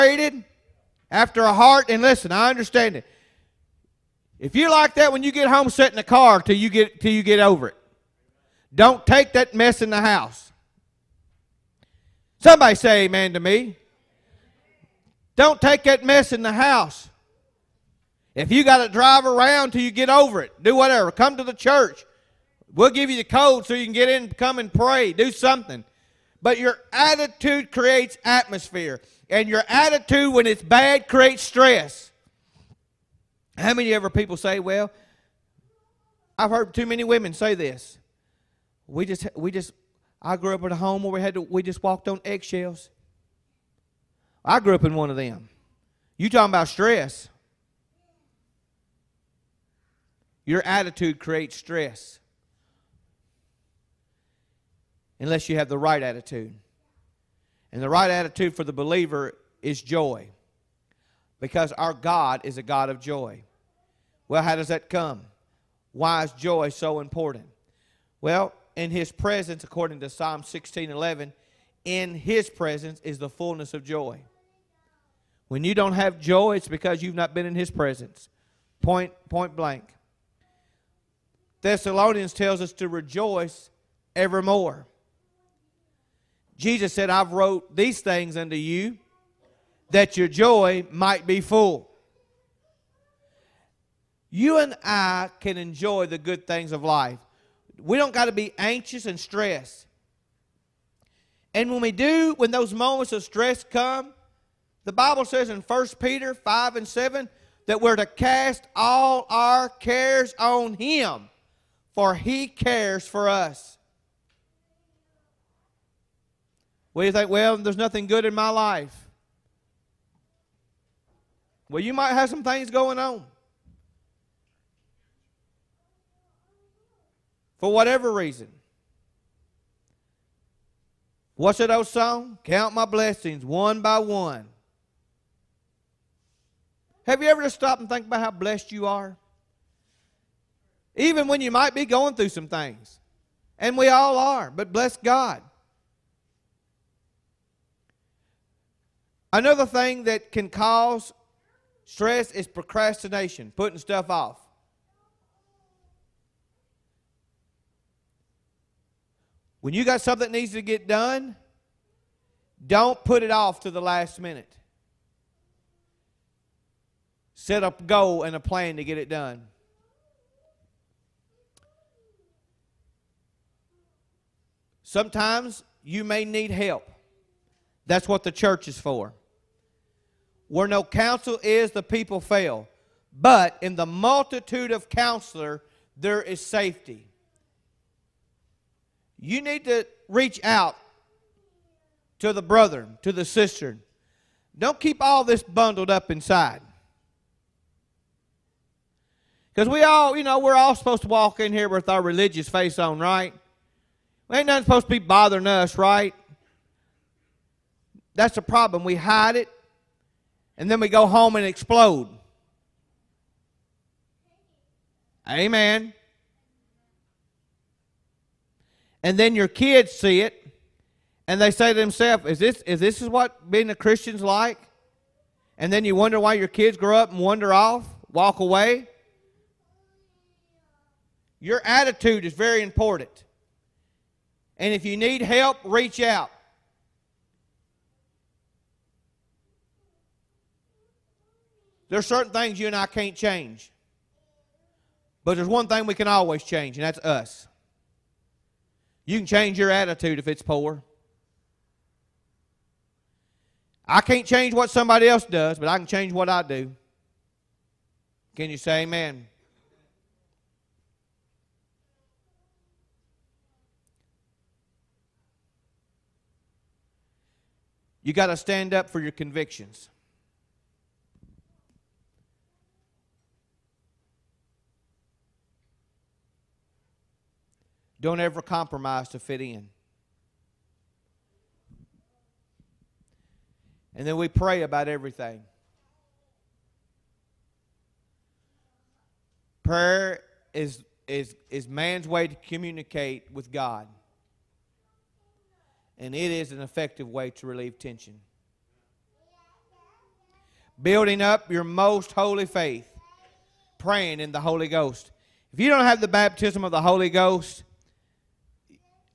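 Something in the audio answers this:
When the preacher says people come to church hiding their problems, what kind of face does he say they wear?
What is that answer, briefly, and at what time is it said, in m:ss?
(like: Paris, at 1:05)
Religious face, at 3:22.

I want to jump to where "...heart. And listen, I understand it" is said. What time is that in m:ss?
0:01.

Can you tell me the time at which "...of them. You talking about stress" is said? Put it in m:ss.
0:45.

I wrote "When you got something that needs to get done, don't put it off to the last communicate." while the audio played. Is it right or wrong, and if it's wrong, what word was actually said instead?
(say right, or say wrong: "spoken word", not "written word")
wrong: "minute", not "communicate".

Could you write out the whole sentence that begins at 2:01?
Well, you might have some things going on.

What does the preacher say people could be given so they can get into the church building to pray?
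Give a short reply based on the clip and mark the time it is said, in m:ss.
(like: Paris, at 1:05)
The code, at 0:23.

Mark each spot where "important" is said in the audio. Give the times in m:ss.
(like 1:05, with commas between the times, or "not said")
1:07, 3:52.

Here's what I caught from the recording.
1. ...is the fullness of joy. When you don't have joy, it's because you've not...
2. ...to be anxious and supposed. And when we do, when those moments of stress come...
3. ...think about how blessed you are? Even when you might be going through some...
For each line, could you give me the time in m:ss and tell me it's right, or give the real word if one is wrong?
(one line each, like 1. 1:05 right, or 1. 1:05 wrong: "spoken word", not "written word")
1. 1:13 right
2. 1:38 wrong: "stressed", not "supposed"
3. 2:17 right.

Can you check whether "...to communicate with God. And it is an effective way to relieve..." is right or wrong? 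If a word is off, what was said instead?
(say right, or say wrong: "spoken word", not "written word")
right.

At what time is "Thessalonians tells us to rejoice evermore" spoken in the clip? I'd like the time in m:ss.
1:21.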